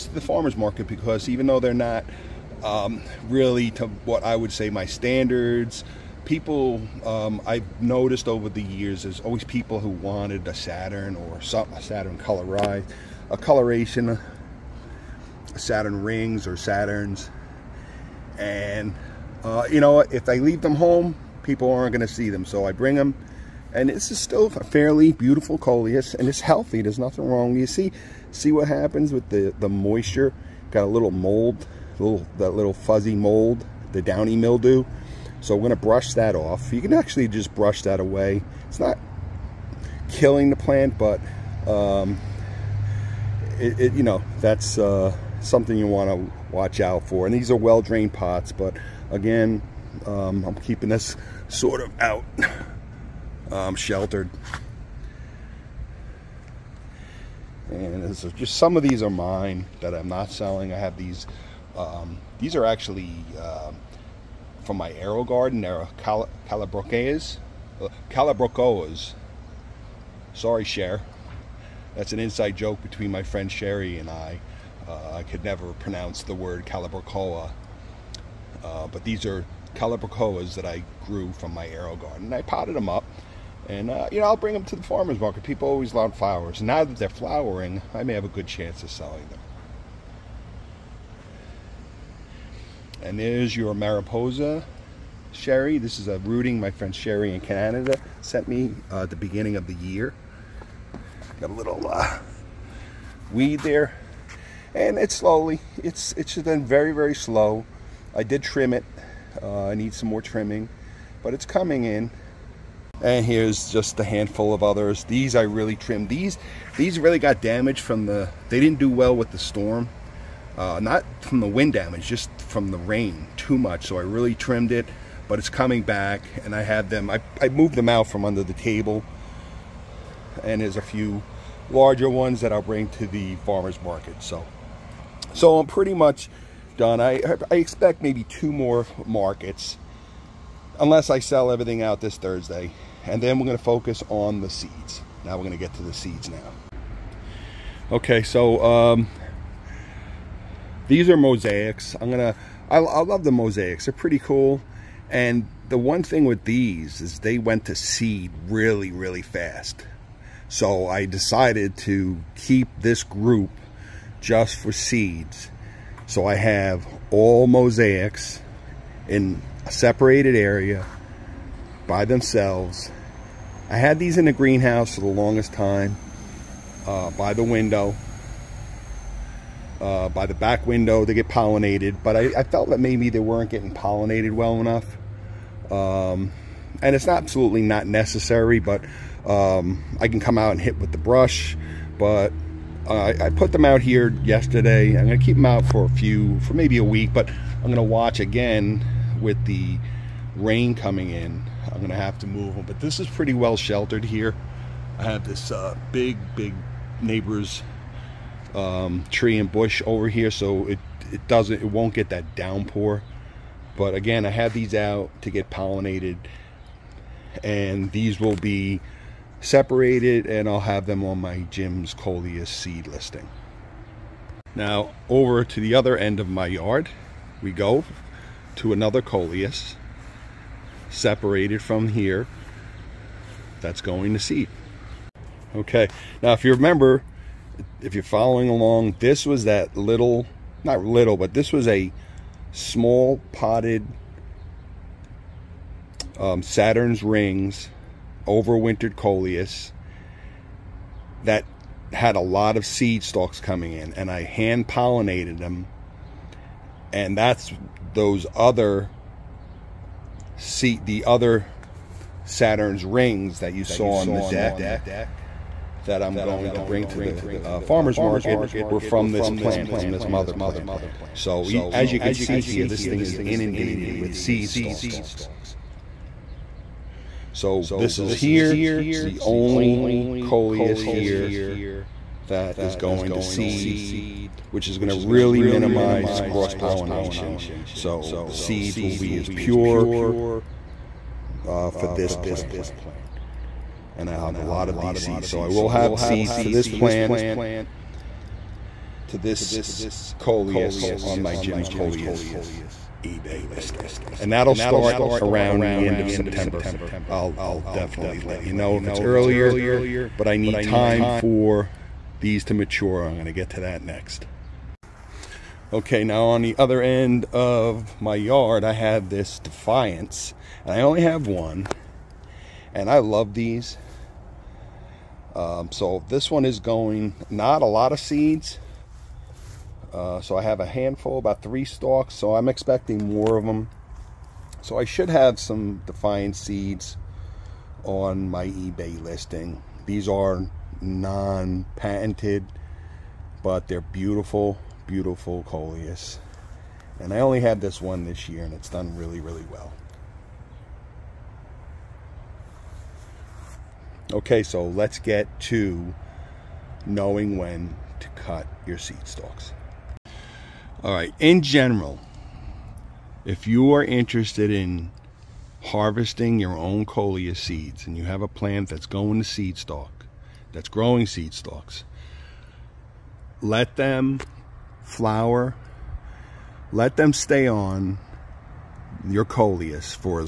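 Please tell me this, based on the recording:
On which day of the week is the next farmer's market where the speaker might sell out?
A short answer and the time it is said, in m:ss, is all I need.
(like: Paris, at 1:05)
Thursday, at 2:22.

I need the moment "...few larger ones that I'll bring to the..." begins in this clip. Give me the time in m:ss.
2:10.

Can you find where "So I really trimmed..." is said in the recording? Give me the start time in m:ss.
2:03.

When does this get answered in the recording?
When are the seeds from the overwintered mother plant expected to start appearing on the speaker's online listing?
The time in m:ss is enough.
5:05.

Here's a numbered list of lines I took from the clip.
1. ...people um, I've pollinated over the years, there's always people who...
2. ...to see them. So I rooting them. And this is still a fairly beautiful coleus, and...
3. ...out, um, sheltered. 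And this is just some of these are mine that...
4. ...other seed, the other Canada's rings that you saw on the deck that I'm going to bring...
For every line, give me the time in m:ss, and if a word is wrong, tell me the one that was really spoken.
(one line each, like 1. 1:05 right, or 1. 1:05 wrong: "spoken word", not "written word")
1. 0:06 wrong: "noticed", not "pollinated"
2. 0:22 wrong: "bring", not "rooting"
3. 0:52 right
4. 4:18 wrong: "Saturn", not "Canada".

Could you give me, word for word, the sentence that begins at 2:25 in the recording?
Now we're going to get to the seeds now.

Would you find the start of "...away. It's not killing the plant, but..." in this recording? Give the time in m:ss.
0:38.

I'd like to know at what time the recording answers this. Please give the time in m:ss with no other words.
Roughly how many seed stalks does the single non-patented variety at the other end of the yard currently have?
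5:31.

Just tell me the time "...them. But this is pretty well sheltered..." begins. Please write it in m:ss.
3:22.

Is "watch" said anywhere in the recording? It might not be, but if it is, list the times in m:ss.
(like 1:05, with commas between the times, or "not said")
0:46, 3:17.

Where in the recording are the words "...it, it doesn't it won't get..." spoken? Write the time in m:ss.
3:30.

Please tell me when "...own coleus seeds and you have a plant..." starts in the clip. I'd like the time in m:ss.
6:06.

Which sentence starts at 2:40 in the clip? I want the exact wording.
So I decided to keep this group just for seeds.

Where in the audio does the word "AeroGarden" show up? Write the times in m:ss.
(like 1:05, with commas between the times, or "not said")
1:04, 1:21.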